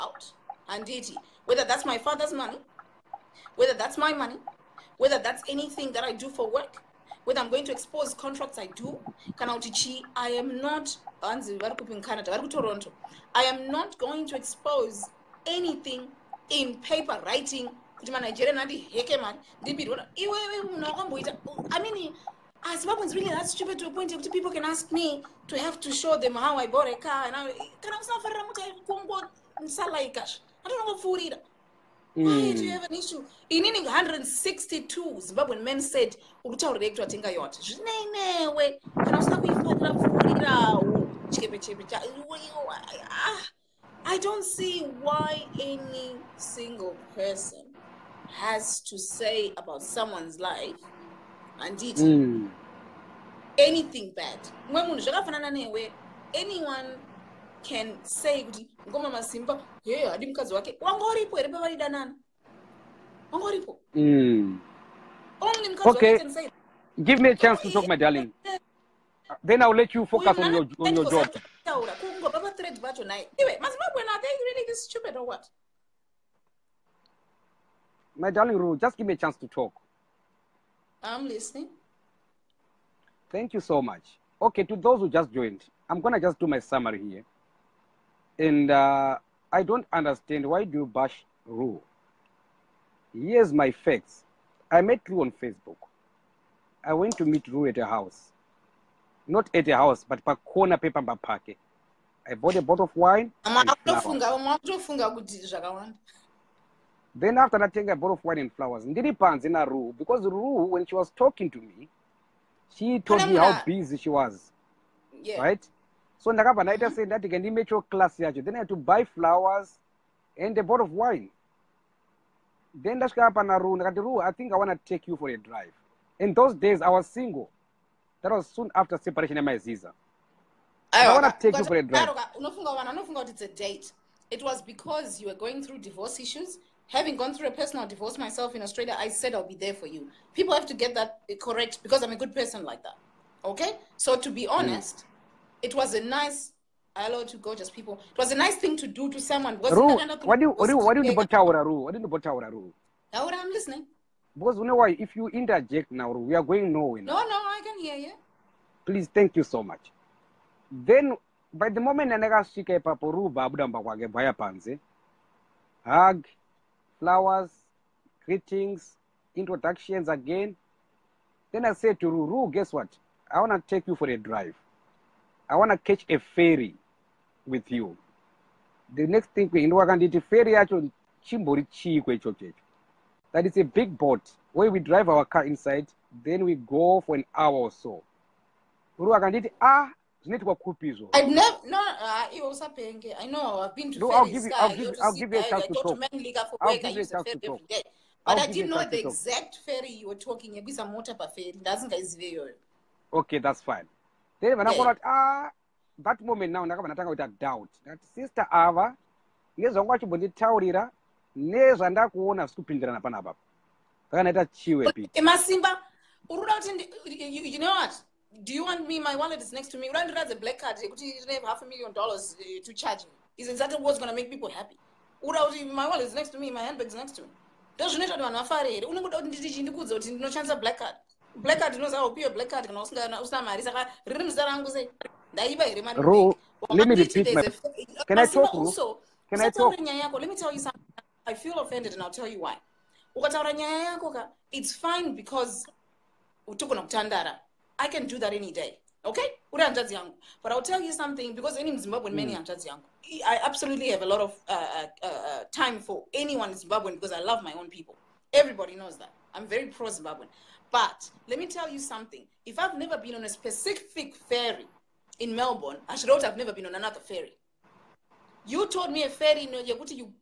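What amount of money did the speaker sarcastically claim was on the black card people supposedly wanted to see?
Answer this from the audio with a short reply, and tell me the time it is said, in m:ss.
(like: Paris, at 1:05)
half a million dollars, at 3:41.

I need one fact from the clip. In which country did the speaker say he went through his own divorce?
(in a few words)
Australia.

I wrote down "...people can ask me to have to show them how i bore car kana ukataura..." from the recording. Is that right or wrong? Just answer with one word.
wrong.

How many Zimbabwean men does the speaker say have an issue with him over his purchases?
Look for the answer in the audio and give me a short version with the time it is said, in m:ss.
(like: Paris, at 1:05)
162, at 0:33.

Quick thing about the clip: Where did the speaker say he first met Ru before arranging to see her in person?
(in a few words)
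Facebook.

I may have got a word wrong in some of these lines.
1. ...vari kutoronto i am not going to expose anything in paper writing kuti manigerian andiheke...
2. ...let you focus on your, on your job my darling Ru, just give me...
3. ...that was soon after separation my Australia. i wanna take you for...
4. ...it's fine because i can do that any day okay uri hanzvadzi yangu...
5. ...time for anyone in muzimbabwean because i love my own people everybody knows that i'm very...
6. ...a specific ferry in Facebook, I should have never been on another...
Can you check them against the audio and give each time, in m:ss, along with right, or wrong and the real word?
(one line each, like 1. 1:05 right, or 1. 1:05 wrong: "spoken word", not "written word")
1. 0:12 right
2. 1:09 right
3. 2:08 wrong: "Ziza", not "Australia"
4. 4:04 right
5. 4:15 wrong: "zimbabwean", not "muzimbabwean"
6. 4:23 wrong: "Melbourne", not "Facebook".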